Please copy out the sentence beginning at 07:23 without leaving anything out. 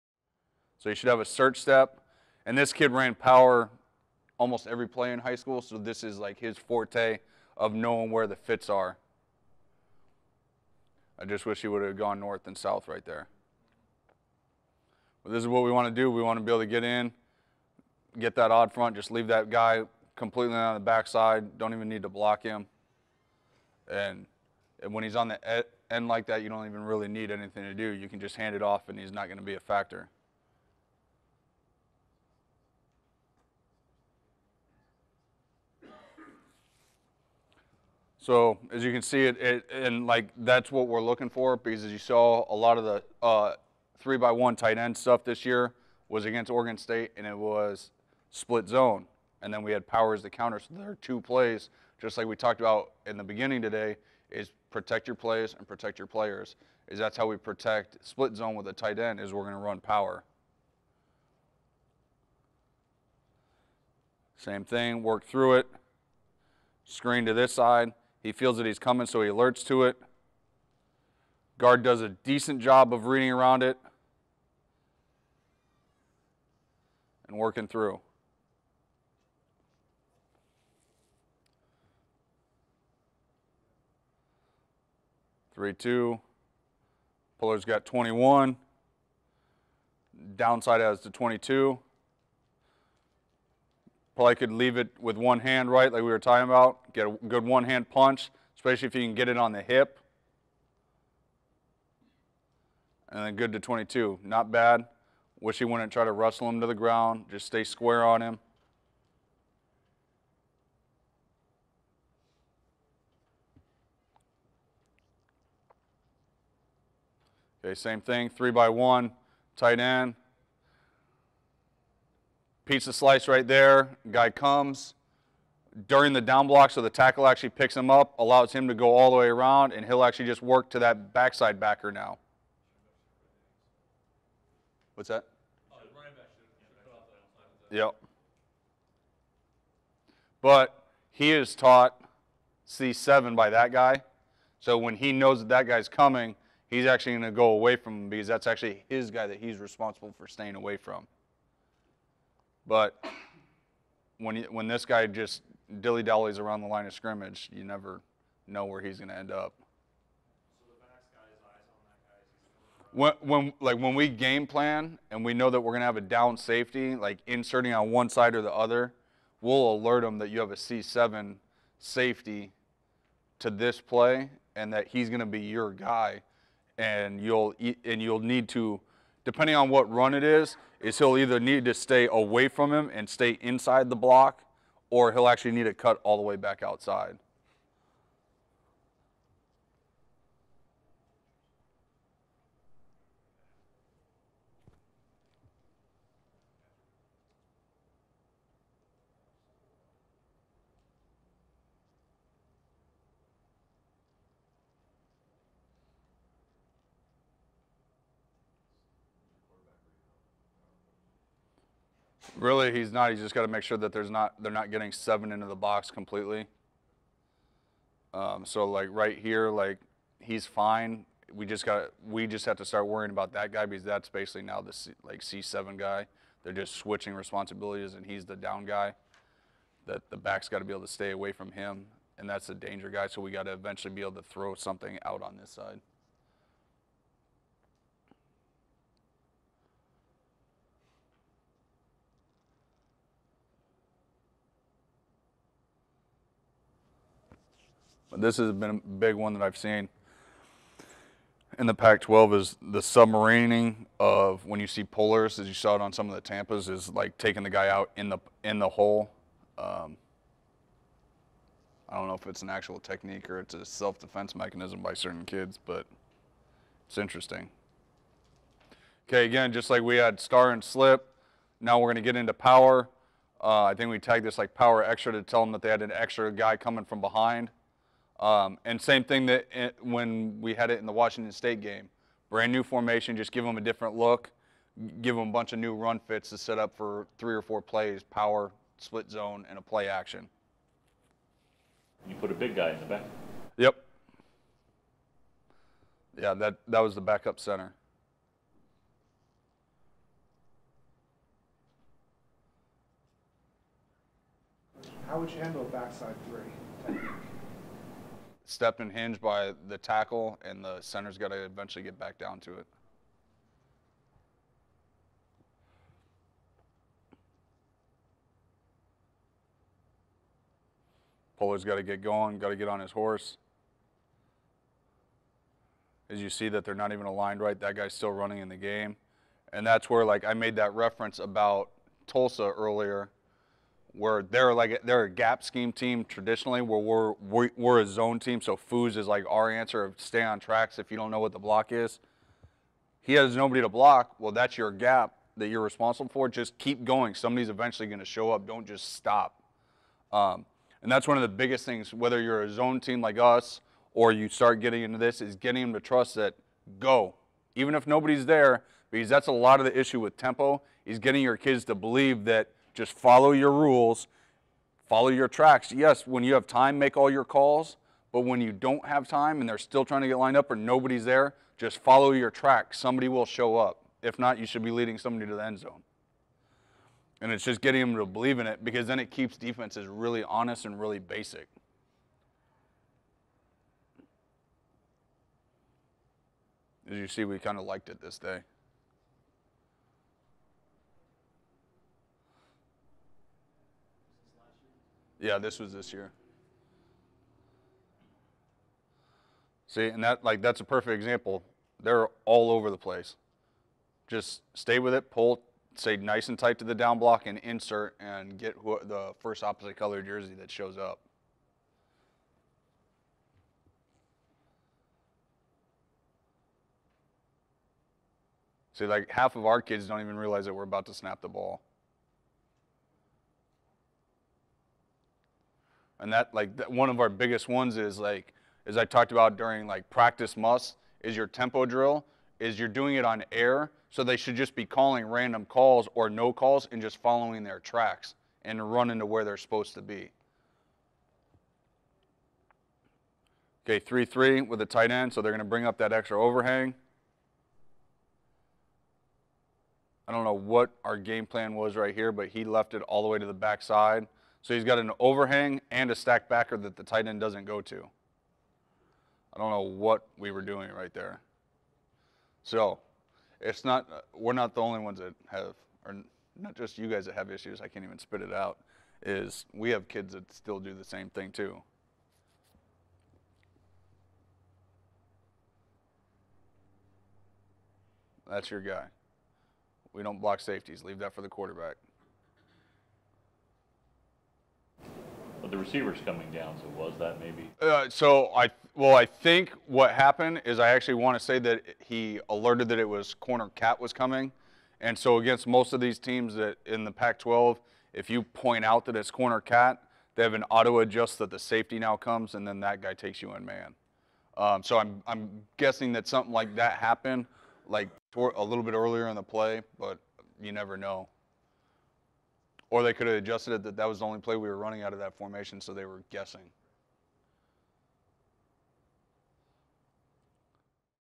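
Okay, 3-3 with a tight end, so they're going to bring up that extra overhang.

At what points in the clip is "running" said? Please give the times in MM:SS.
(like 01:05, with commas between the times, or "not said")
05:28, 07:18, 08:34.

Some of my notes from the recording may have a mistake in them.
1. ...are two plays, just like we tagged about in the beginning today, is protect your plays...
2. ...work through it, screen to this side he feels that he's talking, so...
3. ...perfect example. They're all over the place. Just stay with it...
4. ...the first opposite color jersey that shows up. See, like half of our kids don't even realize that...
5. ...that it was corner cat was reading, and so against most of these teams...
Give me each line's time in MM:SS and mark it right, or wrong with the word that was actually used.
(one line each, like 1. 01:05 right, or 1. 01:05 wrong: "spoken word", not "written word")
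1. 00:50 wrong: "talked", not "tagged"
2. 01:05 wrong: "coming", not "talking"
3. 06:40 right
4. 06:48 right
5. 08:12 wrong: "coming", not "reading".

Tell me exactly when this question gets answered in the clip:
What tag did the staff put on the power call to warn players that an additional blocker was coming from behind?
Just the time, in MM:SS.
04:34.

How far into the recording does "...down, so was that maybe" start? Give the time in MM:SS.
08:06.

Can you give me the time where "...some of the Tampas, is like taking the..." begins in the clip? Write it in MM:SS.
04:15.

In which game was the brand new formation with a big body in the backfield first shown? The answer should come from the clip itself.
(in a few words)
Washington State.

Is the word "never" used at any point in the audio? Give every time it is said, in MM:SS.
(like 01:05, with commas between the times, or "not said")
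02:37, 08:30.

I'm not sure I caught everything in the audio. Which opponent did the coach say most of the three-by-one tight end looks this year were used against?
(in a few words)
Oregon State.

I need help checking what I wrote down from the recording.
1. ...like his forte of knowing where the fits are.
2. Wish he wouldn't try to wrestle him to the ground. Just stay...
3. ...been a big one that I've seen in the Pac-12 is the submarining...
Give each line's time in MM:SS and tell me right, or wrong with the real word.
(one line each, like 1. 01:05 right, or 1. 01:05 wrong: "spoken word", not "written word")
1. 00:06 right
2. 01:45 right
3. 04:08 right.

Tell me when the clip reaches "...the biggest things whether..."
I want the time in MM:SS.
05:51.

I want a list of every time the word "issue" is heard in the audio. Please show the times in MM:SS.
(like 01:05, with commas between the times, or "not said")
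05:59, 07:47.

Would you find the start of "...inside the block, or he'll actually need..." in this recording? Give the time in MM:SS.
03:03.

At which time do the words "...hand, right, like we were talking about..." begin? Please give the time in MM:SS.
01:35.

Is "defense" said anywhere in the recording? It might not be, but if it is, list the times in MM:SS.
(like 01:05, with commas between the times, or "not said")
04:23, 06:19.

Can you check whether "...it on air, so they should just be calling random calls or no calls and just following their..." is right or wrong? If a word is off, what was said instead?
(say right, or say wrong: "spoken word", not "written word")
right.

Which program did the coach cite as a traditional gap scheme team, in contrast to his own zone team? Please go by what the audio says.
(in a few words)
Tulsa.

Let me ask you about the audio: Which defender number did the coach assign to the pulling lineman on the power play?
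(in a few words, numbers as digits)
21.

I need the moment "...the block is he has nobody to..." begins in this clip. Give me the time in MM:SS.
05:41.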